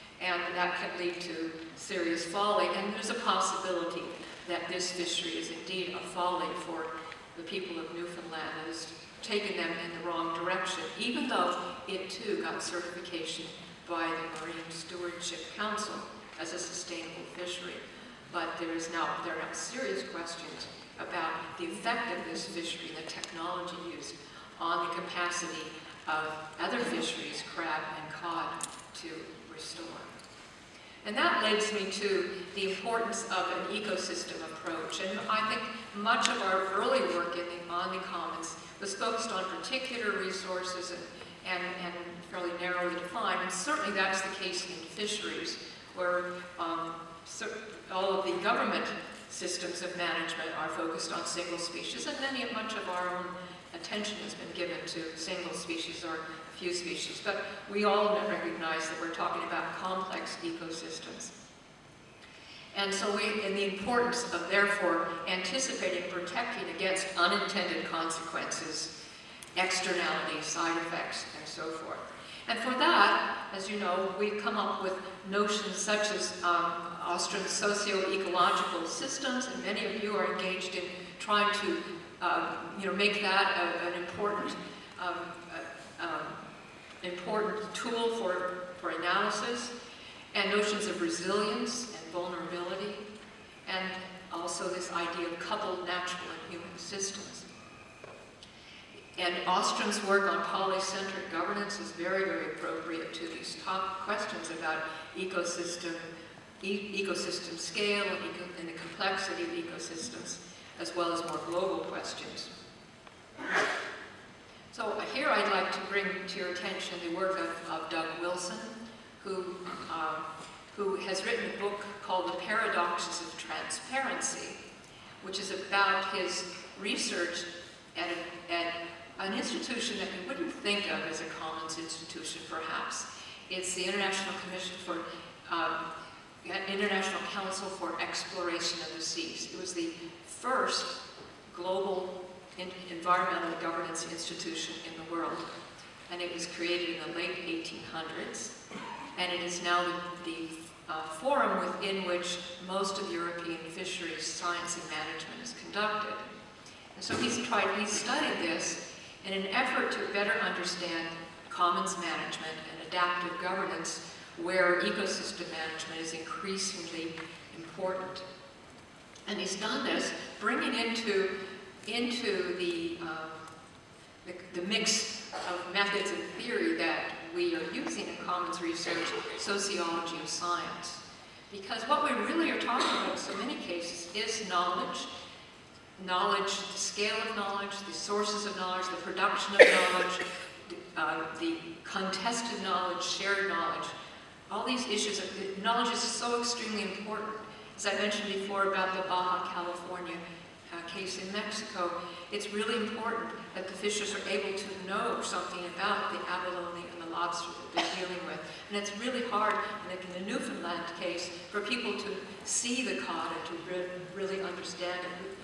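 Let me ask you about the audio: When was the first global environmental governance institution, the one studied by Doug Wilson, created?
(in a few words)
late 1800s.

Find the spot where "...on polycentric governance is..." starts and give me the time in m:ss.
1:40.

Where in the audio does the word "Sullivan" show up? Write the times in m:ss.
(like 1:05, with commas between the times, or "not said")
not said.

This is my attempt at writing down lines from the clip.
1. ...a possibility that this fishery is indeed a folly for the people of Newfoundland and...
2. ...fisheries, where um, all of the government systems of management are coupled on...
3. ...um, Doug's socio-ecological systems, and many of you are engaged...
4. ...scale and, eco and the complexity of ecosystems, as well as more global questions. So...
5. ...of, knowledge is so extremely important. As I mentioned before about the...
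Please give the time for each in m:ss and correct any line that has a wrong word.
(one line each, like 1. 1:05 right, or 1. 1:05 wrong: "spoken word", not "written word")
1. 0:03 right
2. 0:44 wrong: "focused", not "coupled"
3. 1:16 wrong: "Ostrom", not "Doug"
4. 1:47 right
5. 3:15 right.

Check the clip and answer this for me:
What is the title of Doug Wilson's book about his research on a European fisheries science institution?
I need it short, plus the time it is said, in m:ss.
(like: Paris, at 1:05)
The Paradoxes of Transparency, at 2:02.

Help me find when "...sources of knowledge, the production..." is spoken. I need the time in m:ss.
3:07.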